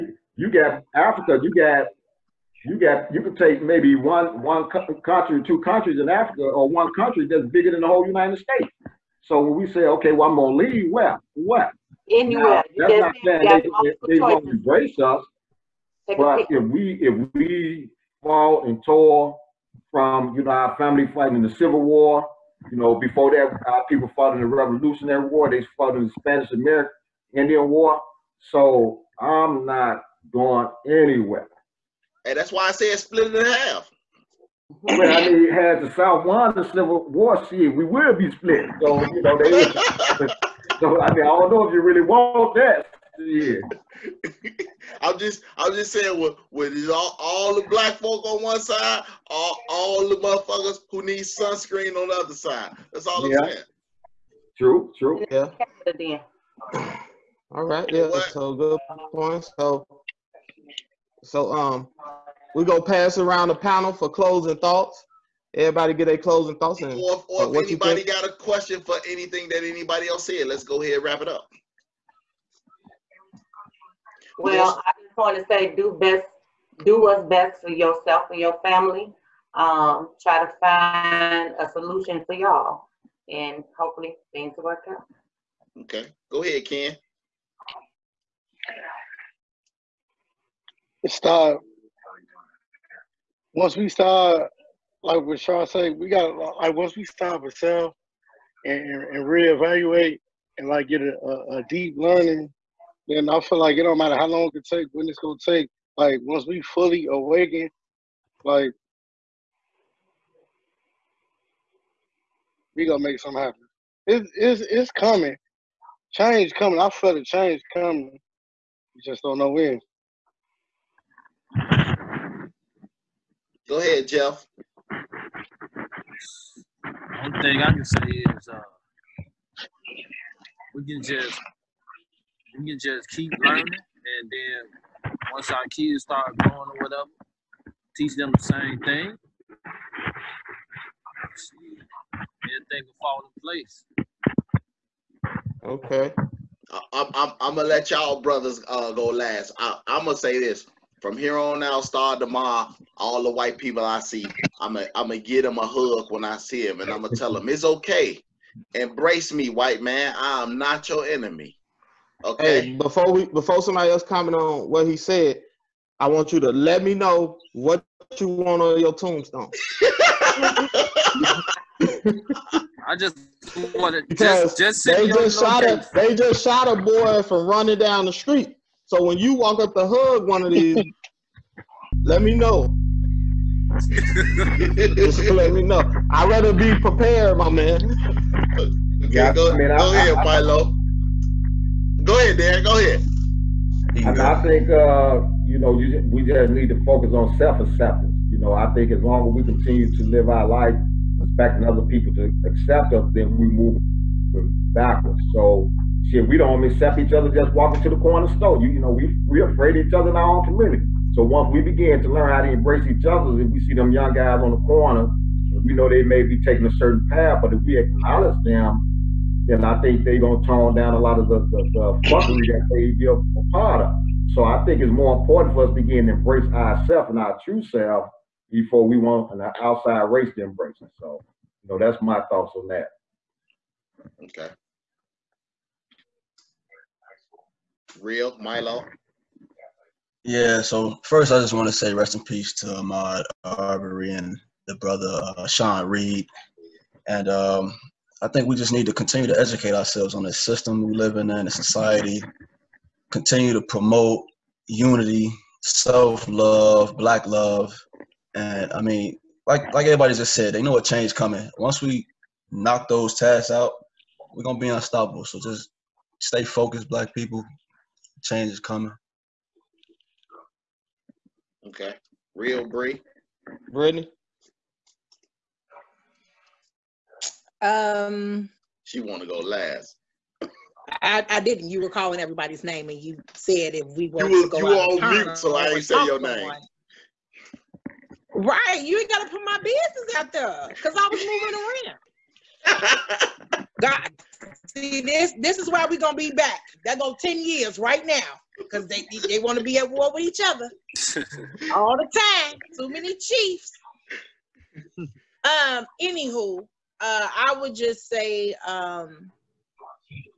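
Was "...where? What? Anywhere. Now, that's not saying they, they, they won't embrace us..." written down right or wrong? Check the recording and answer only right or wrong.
right.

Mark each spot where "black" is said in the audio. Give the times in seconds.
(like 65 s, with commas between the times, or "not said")
47 s, 256 s, 266 s.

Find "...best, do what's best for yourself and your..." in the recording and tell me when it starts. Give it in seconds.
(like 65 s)
75 s.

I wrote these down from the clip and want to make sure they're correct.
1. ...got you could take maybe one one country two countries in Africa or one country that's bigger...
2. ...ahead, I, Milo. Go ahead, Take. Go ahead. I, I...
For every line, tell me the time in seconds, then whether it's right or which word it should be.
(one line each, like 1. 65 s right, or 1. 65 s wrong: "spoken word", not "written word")
1. 2 s right
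2. 189 s wrong: "Dad", not "Take".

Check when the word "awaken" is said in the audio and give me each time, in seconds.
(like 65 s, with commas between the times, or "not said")
107 s.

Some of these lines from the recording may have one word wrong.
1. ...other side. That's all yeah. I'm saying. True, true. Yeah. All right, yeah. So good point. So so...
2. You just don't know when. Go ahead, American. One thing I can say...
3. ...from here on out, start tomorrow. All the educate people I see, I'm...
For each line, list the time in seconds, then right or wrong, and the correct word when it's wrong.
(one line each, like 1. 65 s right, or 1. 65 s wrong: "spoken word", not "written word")
1. 52 s right
2. 118 s wrong: "Jeff", not "American"
3. 151 s wrong: "white", not "educate".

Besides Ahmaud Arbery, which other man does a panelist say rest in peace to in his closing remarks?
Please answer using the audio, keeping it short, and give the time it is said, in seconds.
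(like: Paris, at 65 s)
Sean Reed, at 245 s.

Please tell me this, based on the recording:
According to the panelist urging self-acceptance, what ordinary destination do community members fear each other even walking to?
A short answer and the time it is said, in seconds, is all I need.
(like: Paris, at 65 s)
the corner store, at 207 s.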